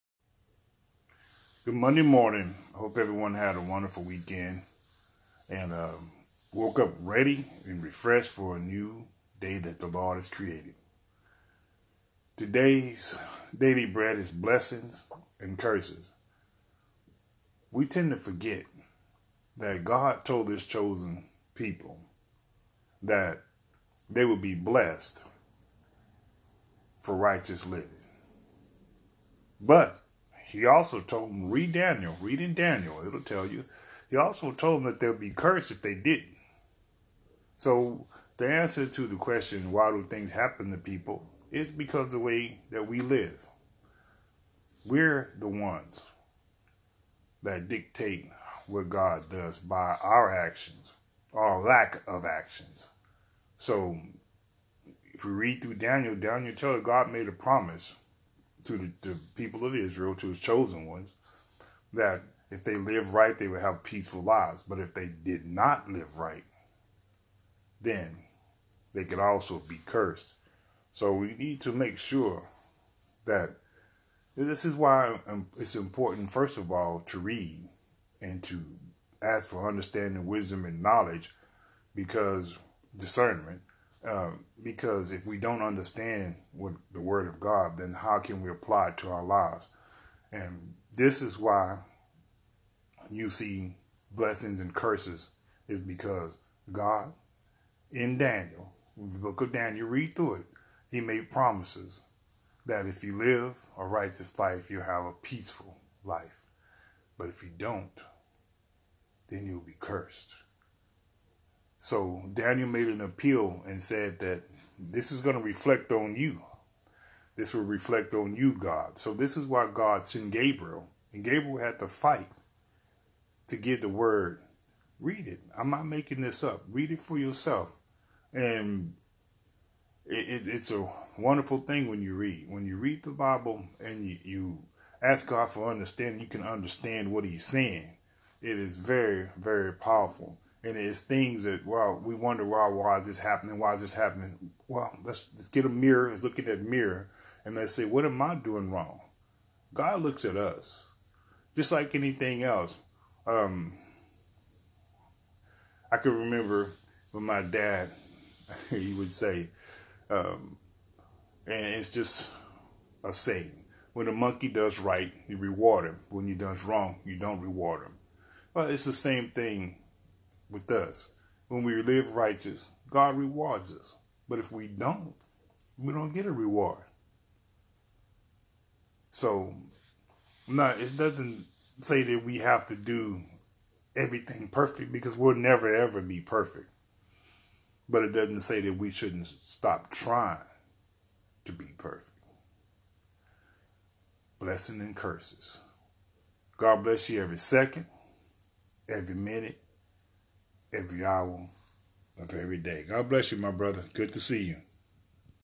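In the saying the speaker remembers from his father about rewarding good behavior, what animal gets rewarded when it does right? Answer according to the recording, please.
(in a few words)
monkey.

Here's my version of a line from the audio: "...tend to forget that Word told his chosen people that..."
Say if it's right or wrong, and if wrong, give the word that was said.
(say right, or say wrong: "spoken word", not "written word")
wrong: "God", not "Word".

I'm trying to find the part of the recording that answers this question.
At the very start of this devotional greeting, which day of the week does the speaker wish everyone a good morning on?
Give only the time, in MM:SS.
00:01.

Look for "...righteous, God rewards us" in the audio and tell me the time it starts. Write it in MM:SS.
02:52.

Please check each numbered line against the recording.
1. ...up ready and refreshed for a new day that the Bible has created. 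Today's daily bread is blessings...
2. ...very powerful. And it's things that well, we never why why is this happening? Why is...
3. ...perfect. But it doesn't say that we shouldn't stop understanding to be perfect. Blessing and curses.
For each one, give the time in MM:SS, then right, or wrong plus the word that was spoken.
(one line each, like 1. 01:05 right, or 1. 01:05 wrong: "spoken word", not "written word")
1. 00:06 wrong: "Lord", not "Bible"
2. 02:19 wrong: "wonder", not "never"
3. 03:06 wrong: "trying", not "understanding".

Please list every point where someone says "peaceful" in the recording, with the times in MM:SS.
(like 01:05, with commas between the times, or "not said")
01:03, 01:45.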